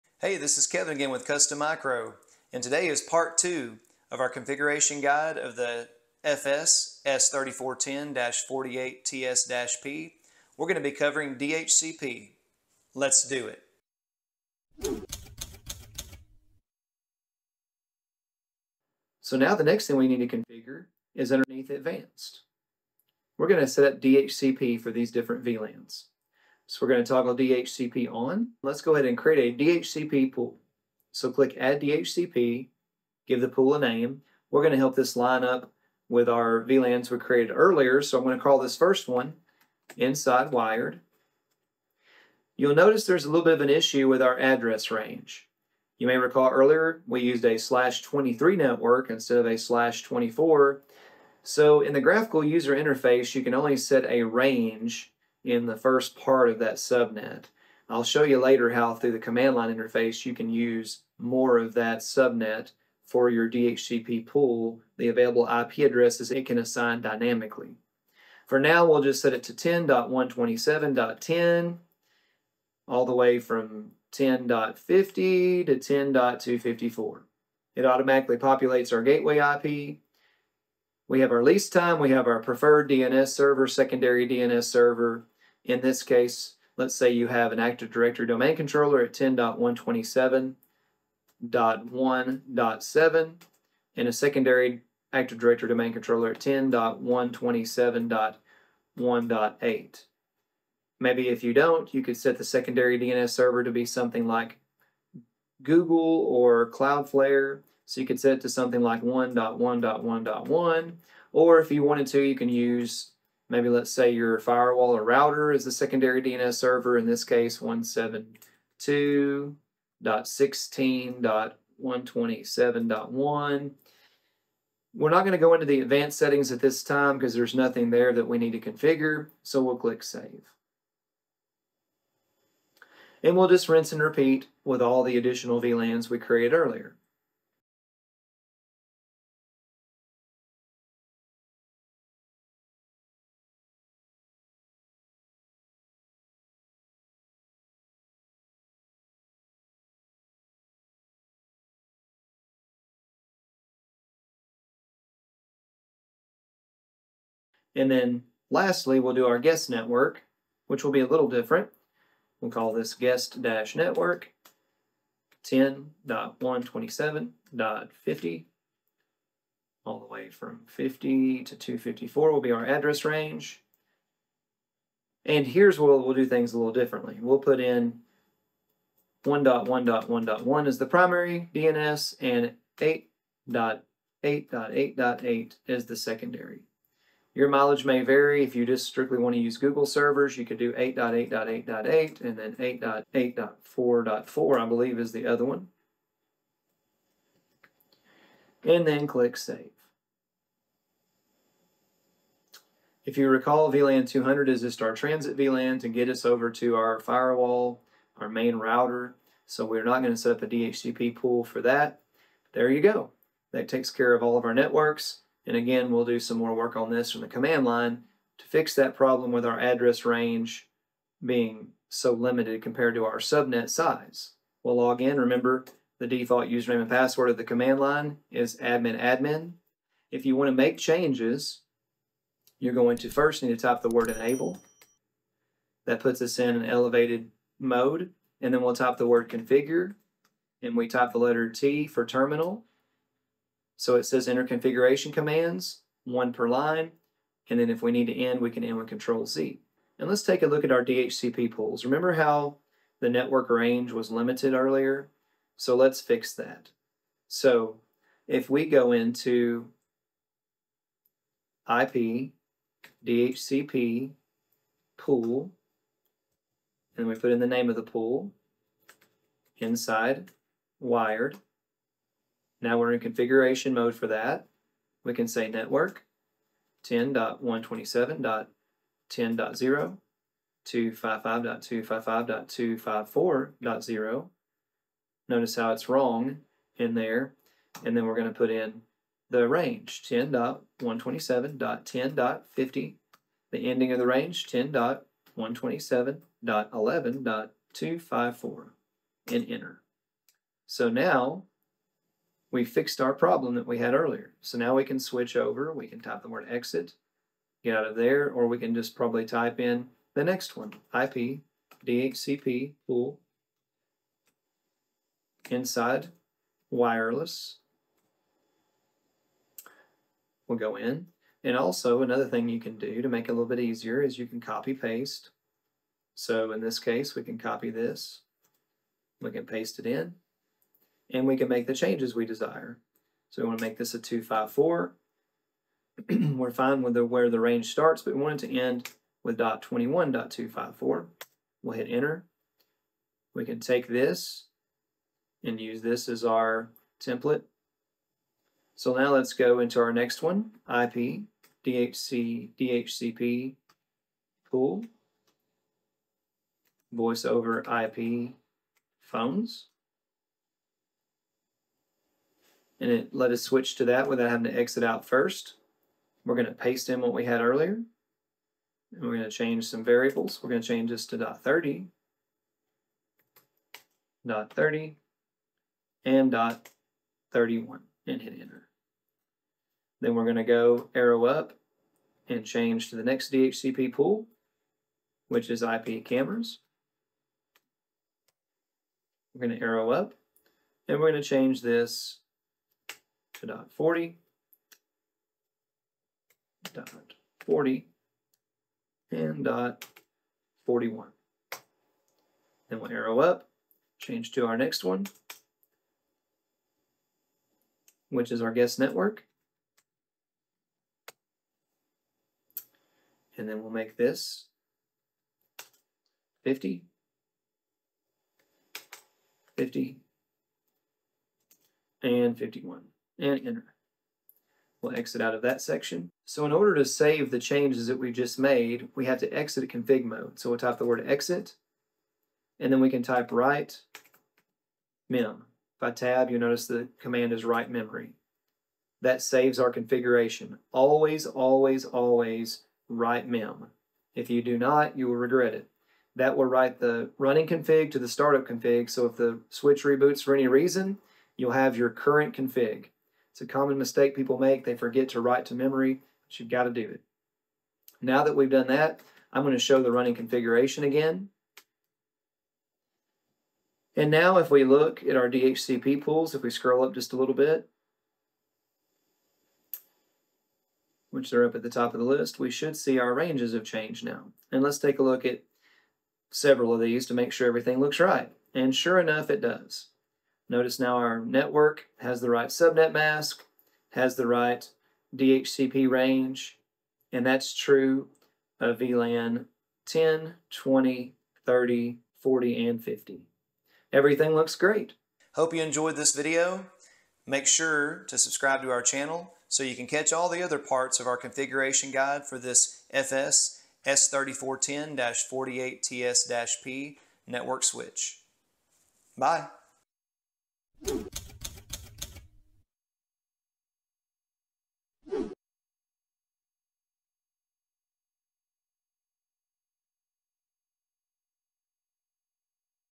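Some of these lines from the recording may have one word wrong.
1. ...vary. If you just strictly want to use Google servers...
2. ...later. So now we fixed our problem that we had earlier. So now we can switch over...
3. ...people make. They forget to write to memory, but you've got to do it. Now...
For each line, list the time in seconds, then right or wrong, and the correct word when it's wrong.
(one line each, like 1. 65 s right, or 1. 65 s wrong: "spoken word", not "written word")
1. 188 s right
2. 299 s wrong: "enter", not "later"
3. 454 s right.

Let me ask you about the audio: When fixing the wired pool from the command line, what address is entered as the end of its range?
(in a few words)
10.127.11.254.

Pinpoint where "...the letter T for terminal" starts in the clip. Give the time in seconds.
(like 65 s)
241 s.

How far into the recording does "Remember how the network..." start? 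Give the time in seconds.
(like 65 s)
251 s.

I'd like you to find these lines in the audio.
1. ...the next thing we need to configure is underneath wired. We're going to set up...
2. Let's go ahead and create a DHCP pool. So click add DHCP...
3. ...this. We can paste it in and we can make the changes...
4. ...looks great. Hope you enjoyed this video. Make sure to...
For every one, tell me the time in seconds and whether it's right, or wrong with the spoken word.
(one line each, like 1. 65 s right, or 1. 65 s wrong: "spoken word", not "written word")
1. 19 s wrong: "advanced", not "wired"
2. 28 s right
3. 327 s right
4. 494 s right.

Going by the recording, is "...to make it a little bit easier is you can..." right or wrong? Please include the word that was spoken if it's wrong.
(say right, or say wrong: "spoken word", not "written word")
right.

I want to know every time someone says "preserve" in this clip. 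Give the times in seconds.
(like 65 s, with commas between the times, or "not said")
not said.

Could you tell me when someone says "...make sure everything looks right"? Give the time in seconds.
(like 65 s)
477 s.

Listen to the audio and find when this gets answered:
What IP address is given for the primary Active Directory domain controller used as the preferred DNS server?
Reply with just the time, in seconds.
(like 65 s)
89 s.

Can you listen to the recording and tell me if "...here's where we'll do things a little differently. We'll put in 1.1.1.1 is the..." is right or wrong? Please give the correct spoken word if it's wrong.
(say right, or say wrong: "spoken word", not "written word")
right.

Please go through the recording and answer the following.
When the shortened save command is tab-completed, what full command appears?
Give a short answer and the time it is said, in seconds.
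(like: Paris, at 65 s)
write memory, at 437 s.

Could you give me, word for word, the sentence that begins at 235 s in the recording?
That puts us in an elevated mode.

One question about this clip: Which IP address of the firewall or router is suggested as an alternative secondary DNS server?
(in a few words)
172.16.127.1.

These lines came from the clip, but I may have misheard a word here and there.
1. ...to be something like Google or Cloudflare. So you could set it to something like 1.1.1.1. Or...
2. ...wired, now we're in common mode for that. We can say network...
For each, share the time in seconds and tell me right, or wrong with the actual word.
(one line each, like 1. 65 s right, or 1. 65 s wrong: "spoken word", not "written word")
1. 103 s right
2. 270 s wrong: "configuration", not "common".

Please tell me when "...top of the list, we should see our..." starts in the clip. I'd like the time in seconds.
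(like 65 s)
471 s.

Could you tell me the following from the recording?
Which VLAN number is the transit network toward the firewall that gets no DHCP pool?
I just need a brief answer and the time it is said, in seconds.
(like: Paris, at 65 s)
200, at 203 s.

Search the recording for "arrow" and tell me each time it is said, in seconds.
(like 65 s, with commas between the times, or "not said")
380 s, 389 s, 402 s.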